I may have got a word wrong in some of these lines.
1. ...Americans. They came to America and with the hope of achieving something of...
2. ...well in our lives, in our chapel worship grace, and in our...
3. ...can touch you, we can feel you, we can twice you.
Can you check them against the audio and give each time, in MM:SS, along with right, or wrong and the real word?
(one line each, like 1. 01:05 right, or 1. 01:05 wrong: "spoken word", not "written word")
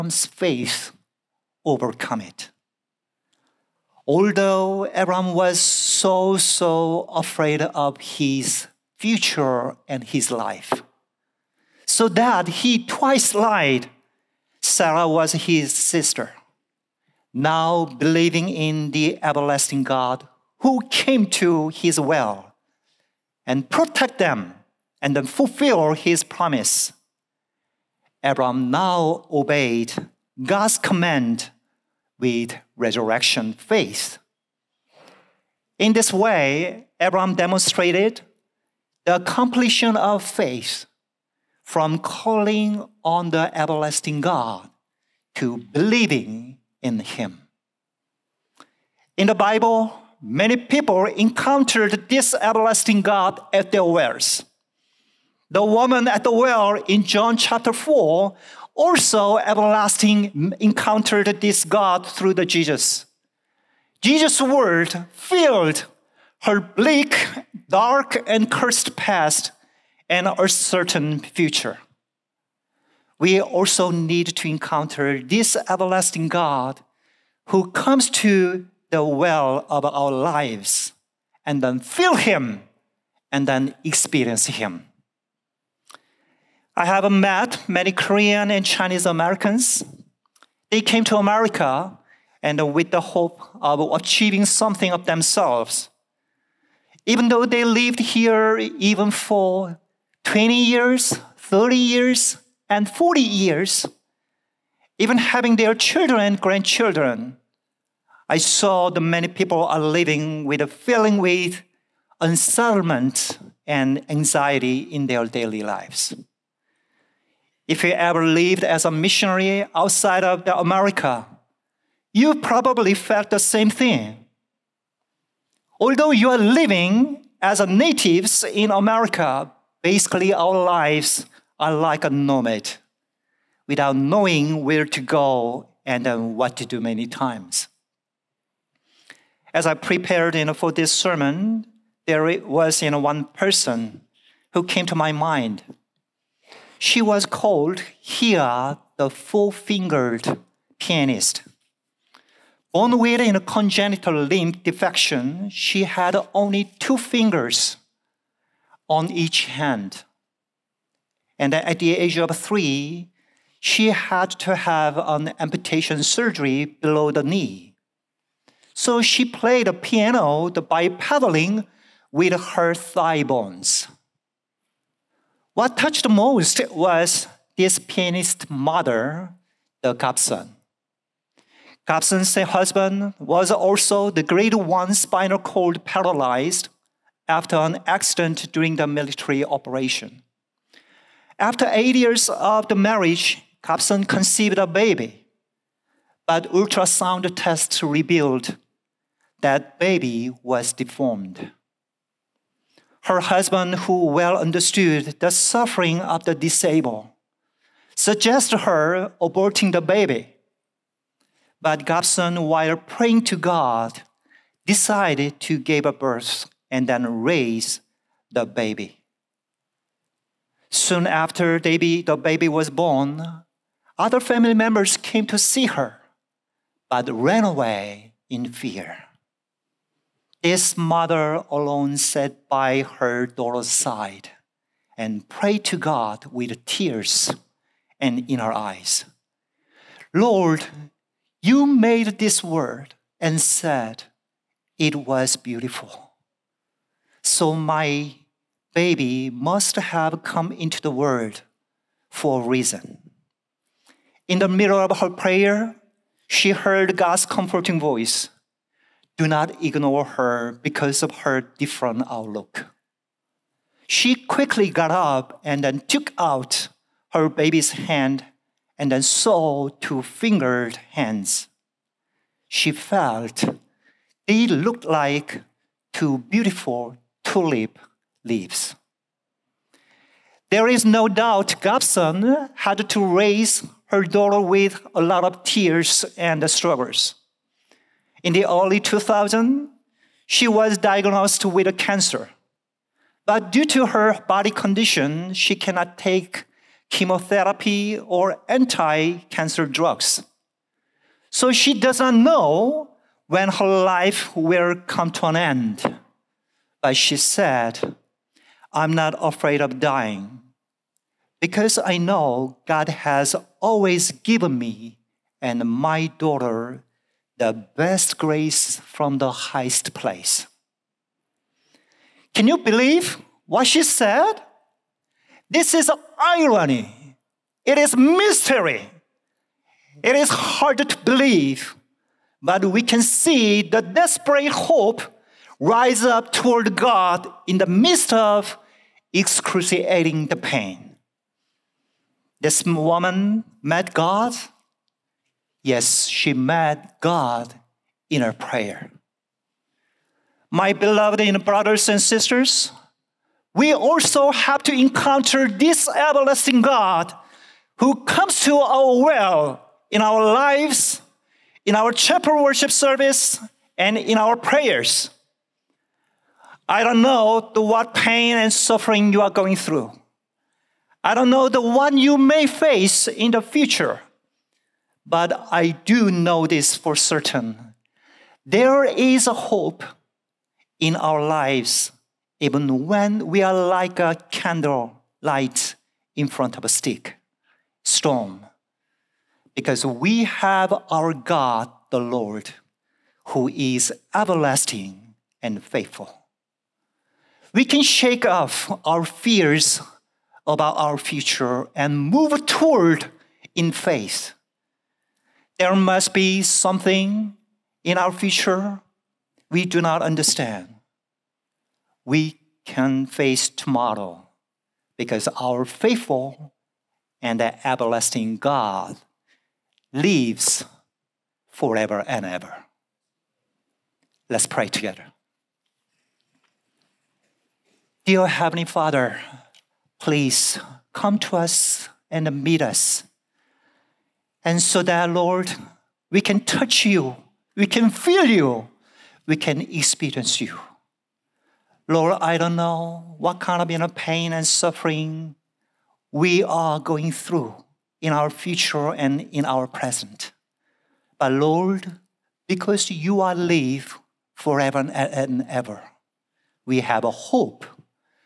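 1. 01:29 right
2. 05:59 wrong: "service", not "grace"
3. 07:16 wrong: "experience", not "twice".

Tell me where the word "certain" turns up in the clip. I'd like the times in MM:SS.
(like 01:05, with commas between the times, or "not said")
01:10, 06:16.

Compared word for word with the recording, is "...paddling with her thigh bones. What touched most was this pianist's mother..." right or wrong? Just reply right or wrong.
right.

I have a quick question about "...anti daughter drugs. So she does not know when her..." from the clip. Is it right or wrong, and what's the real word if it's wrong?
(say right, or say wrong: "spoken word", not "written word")
wrong: "cancer", not "daughter".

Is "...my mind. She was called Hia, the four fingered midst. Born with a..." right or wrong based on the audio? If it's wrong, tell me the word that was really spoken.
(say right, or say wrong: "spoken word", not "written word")
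wrong: "pianist", not "midst".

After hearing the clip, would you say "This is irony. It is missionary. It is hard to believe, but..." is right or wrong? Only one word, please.
wrong.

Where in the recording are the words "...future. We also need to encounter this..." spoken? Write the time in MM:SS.
01:11.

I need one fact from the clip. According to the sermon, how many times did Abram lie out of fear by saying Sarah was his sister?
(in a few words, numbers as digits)
2.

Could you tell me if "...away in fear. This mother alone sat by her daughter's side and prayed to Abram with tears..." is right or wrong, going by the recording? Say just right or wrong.
wrong.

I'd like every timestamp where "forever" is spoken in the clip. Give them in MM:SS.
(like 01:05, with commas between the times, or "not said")
07:01, 07:34.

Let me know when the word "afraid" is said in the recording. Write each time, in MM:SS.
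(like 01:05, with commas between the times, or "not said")
00:07, 05:09.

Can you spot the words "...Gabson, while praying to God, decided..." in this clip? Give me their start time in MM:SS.
03:31.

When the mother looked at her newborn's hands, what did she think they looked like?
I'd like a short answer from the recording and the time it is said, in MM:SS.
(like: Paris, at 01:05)
Two beautiful tulip leaves, at 04:35.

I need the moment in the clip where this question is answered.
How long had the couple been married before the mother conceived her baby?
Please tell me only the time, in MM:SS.
03:11.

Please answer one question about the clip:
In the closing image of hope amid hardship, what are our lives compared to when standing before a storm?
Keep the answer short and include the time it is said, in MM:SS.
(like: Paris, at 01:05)
Candle light, at 06:24.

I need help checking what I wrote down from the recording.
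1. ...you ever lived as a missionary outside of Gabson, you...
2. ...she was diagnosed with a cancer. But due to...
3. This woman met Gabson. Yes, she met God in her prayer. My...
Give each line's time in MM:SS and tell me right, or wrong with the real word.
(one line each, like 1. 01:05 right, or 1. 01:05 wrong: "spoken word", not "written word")
1. 01:57 wrong: "America", not "Gabson"
2. 04:50 right
3. 05:42 wrong: "God", not "Gabson".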